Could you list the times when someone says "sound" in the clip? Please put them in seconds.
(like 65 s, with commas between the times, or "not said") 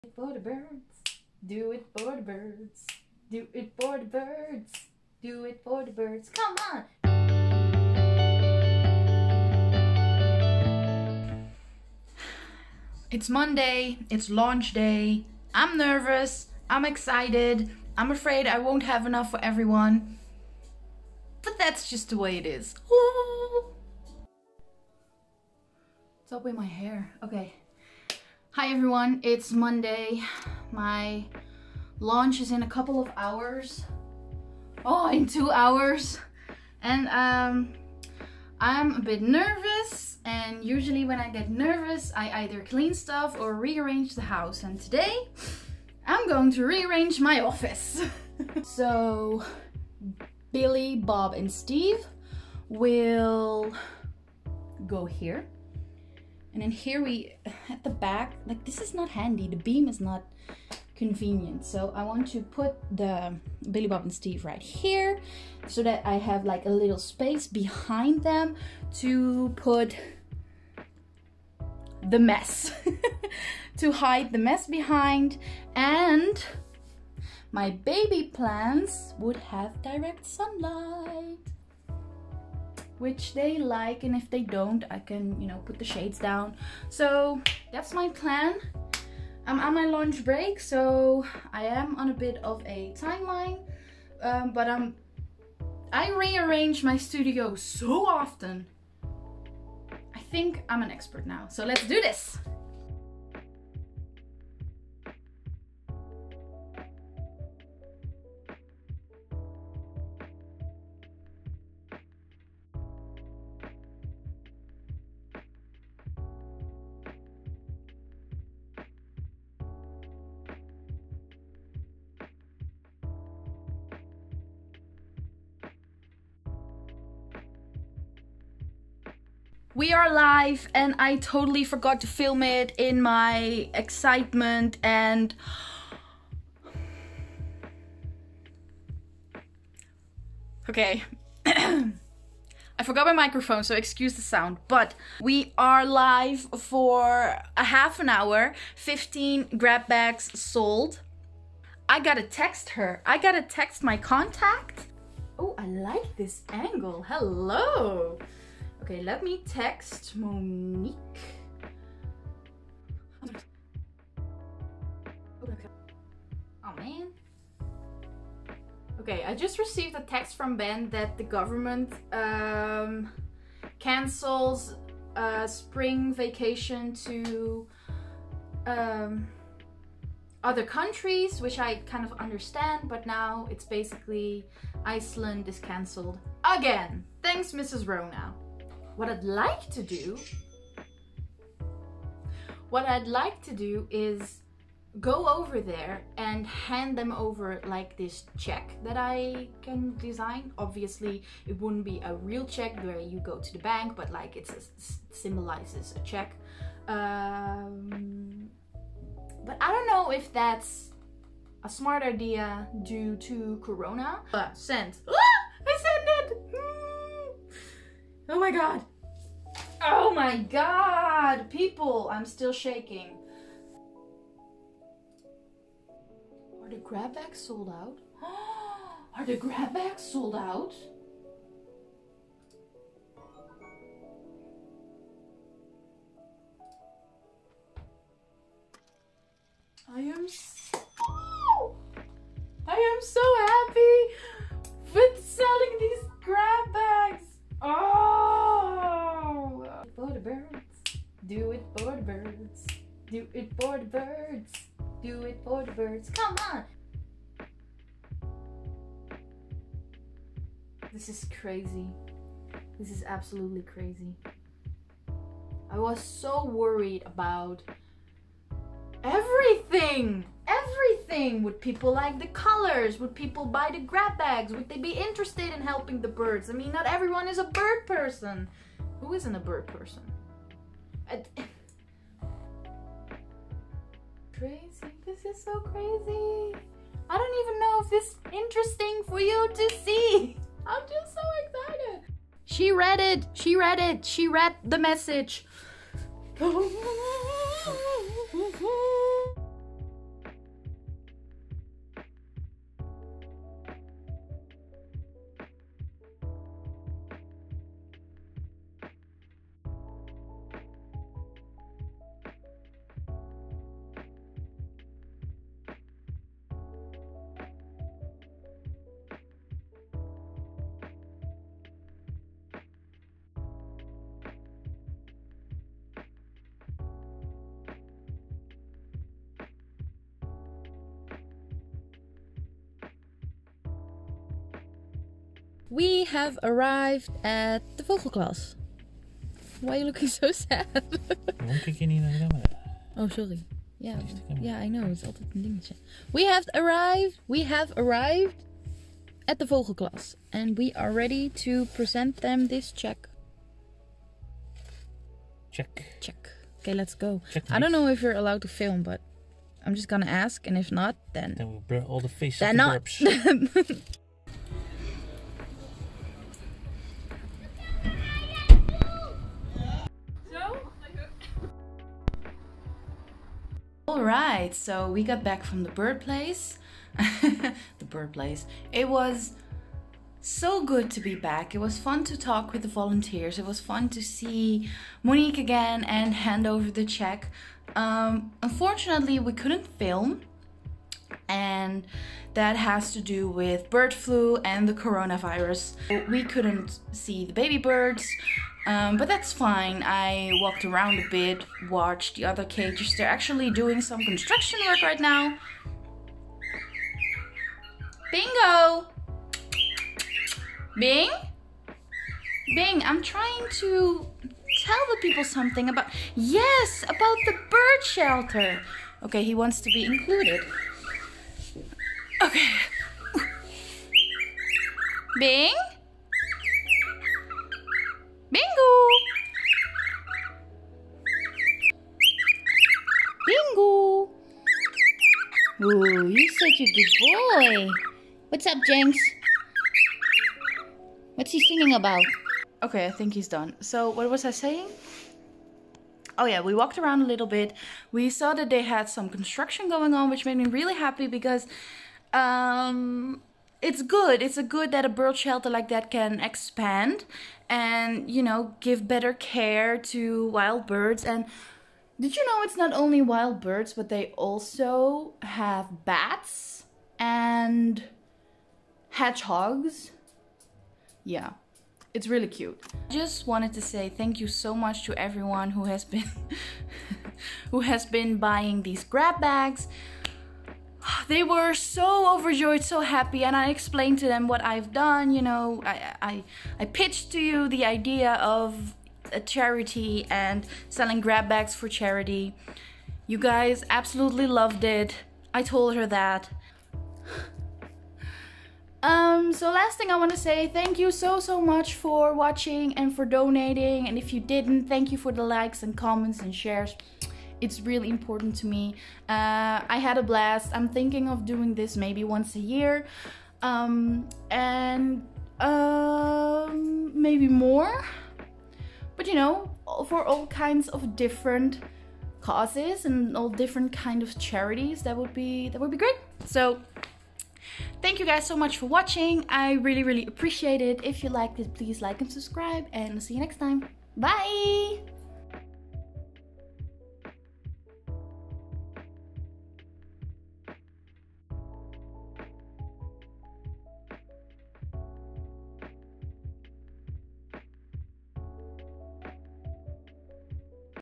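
144 s.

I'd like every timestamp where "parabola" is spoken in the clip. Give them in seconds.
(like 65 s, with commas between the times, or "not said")
not said.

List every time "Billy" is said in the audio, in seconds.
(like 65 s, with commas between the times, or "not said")
50 s, 63 s.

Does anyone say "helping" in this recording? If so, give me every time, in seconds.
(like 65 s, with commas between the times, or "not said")
275 s.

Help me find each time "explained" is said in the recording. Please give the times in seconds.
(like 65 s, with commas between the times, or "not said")
483 s.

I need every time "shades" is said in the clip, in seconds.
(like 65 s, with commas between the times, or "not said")
85 s.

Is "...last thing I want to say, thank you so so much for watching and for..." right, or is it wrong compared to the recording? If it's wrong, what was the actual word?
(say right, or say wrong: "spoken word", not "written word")
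right.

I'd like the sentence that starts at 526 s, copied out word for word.
So Thank you guys so much for watching.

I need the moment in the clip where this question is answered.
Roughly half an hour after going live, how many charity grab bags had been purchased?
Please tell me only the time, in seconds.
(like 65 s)
148 s.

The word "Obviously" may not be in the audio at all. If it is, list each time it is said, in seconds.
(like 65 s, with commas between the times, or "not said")
200 s.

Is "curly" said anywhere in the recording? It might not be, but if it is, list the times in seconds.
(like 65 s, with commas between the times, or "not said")
not said.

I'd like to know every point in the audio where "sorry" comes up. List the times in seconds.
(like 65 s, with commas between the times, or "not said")
343 s.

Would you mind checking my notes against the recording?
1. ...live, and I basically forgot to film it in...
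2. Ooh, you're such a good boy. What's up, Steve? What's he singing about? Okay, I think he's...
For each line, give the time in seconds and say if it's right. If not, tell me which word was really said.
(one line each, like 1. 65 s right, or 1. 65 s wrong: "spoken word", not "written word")
1. 130 s wrong: "totally", not "basically"
2. 435 s wrong: "Jenks", not "Steve".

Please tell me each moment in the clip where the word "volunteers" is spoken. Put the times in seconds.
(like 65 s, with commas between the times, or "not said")
382 s.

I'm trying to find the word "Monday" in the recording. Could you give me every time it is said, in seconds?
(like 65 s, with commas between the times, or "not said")
13 s, 29 s.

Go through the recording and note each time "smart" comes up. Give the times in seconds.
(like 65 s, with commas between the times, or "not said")
211 s.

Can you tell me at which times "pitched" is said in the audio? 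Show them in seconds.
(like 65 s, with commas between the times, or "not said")
486 s.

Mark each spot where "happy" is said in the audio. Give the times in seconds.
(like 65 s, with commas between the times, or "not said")
450 s, 482 s.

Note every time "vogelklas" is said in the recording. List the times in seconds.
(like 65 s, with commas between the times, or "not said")
337 s, 349 s.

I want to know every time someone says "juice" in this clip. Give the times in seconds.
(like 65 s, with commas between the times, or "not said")
not said.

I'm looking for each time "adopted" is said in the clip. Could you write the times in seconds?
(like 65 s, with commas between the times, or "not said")
not said.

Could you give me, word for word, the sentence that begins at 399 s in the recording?
I walked around a bit, watched the other cages.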